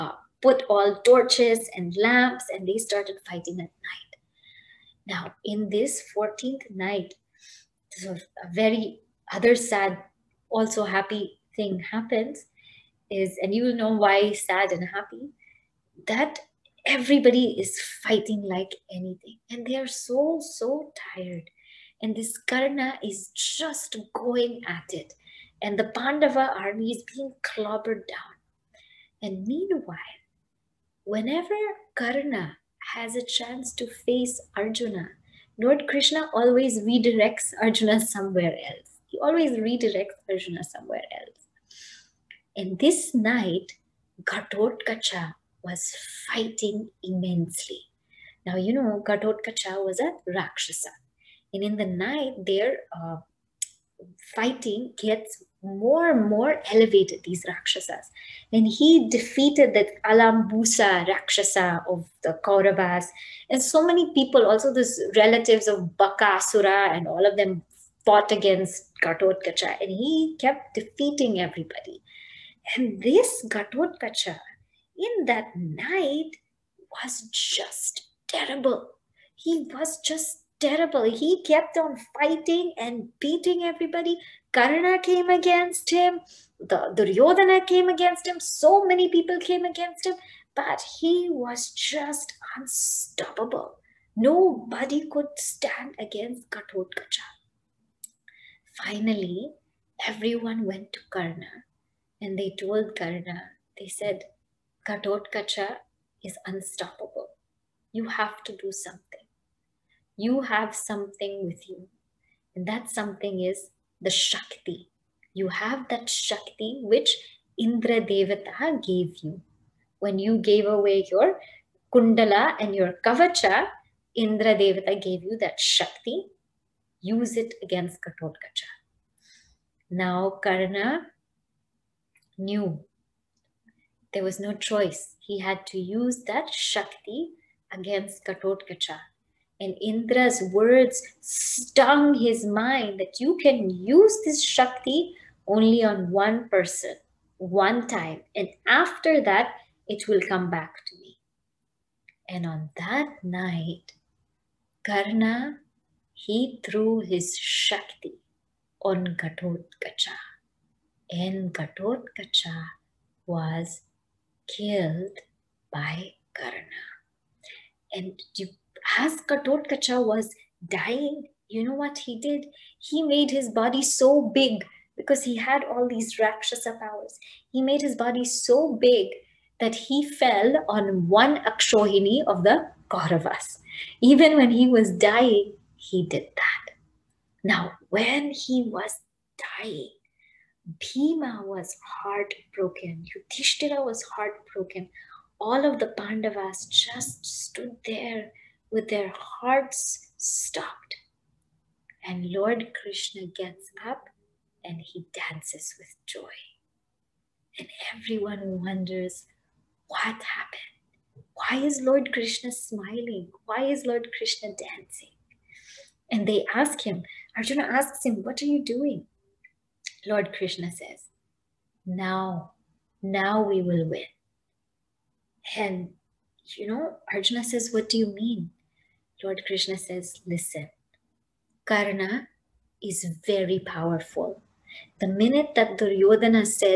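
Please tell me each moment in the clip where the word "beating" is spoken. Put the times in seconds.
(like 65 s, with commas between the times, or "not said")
83 s.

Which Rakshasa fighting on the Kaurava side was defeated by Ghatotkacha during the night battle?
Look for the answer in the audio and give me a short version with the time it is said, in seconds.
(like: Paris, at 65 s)
Alambusa, at 60 s.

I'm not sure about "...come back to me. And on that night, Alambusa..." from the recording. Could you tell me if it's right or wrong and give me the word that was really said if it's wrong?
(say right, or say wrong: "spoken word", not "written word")
wrong: "Karna", not "Alambusa".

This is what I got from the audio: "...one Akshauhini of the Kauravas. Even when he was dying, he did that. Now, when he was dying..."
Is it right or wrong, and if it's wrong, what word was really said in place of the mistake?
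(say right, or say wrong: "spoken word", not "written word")
right.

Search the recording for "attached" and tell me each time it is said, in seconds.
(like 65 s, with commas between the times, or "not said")
not said.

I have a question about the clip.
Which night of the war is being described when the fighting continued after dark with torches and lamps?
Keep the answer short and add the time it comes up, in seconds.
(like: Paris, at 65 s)
14th night, at 6 s.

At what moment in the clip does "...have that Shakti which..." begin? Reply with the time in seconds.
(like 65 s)
115 s.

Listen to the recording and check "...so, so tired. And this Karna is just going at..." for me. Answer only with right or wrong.
right.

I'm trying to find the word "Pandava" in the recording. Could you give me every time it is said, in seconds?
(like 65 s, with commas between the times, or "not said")
25 s, 195 s.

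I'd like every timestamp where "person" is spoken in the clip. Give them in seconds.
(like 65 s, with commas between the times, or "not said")
146 s.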